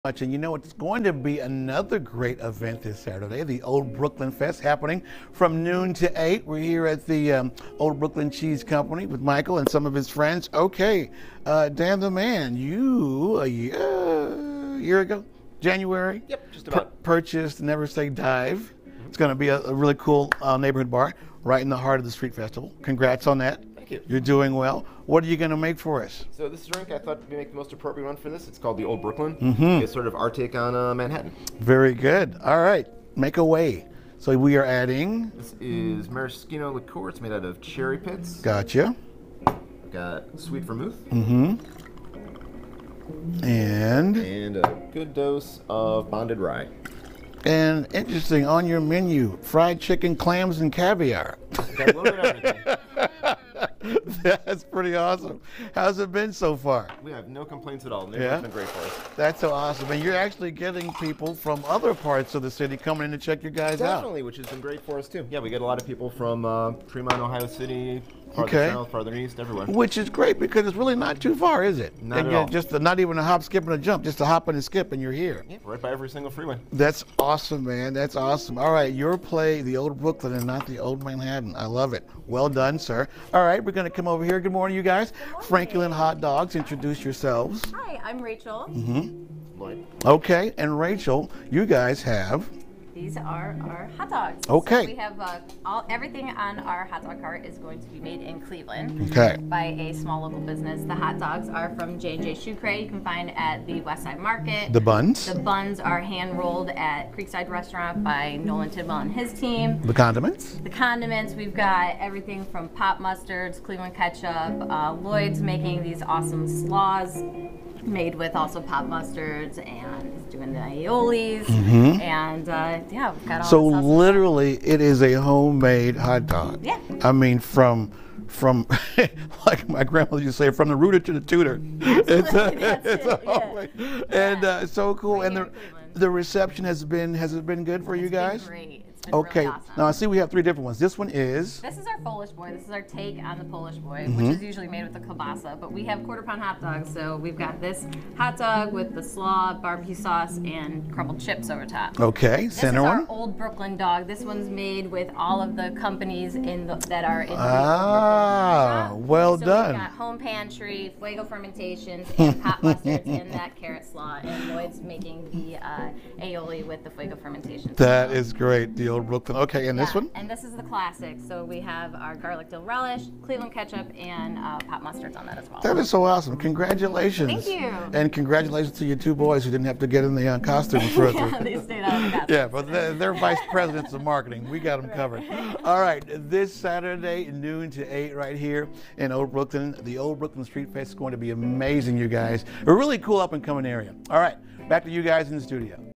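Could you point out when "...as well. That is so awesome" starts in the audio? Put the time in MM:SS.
02:55.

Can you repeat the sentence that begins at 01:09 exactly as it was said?
Which is great because it's really not too far, is it?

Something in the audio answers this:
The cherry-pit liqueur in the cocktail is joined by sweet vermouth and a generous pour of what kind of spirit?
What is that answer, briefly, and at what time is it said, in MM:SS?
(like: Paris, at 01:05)
bonded rye, at 00:46.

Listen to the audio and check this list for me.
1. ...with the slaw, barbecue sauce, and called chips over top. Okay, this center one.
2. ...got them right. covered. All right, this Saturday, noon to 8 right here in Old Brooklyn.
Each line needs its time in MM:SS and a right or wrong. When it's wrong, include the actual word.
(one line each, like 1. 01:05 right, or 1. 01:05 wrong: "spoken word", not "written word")
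1. 02:28 wrong: "crumbled", not "called"
2. 03:04 right.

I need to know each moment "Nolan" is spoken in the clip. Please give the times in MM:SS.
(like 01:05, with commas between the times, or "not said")
01:48.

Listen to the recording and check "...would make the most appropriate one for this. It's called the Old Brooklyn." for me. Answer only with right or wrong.
right.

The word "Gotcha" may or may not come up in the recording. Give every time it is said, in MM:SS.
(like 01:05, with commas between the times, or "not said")
00:38.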